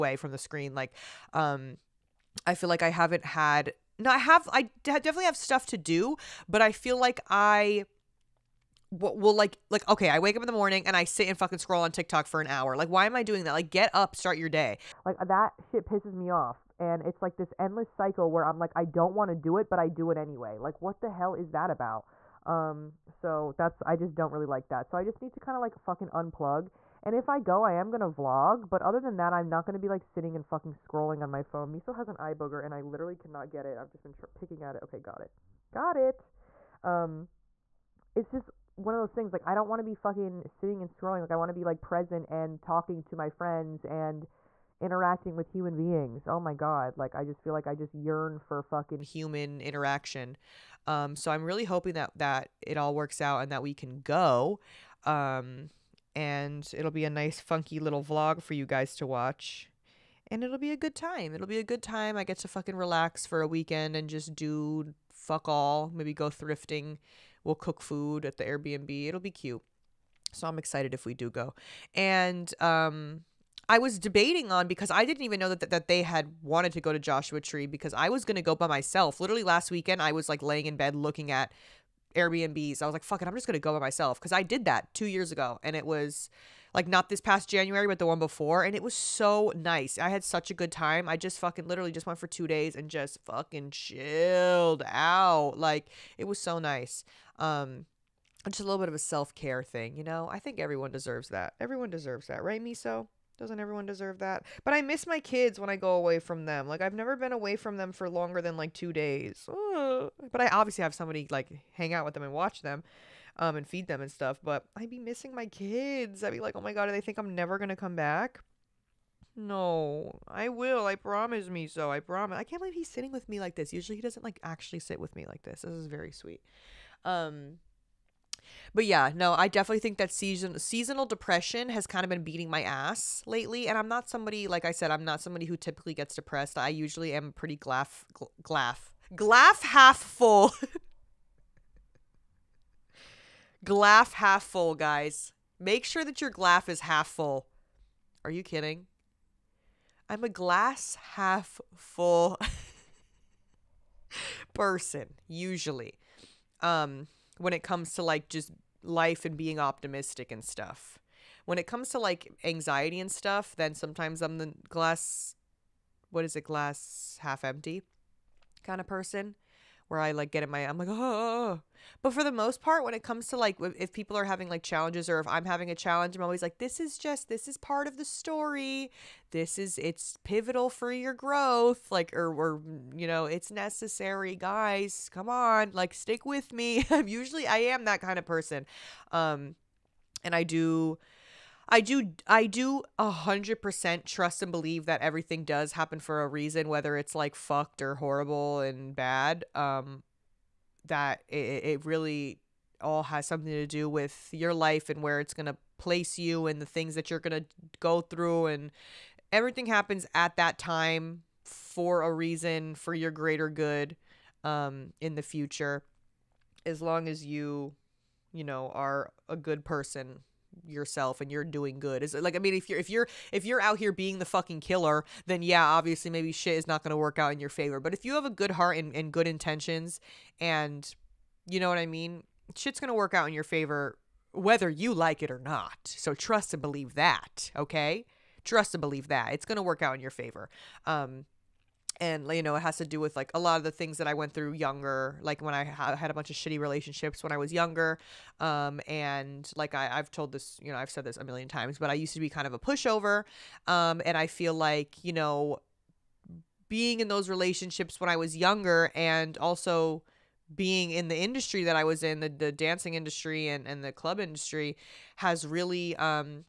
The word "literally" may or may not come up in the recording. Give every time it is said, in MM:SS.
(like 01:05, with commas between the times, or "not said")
00:32, 01:19, 01:31.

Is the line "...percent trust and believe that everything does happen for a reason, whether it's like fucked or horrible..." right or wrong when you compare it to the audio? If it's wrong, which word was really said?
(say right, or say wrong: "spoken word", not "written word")
right.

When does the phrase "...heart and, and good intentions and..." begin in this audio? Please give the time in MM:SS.
03:48.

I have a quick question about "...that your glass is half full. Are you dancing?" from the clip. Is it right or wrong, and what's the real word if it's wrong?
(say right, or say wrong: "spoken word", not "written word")
wrong: "kidding", not "dancing".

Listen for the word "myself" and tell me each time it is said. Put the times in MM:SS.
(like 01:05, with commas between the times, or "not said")
01:18, 01:23.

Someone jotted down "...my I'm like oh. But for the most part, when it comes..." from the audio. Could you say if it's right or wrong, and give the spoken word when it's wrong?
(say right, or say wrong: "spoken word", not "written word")
right.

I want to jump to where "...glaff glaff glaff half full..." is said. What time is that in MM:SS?
02:17.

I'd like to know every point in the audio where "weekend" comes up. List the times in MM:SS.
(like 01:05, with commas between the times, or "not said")
01:03, 01:19.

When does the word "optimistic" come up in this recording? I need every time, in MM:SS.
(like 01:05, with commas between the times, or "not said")
02:39.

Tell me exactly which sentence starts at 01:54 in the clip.
But I'd be missing my kids.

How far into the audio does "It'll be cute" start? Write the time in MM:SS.
01:09.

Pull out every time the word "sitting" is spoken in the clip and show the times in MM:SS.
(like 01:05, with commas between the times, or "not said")
00:30, 00:40, 02:02.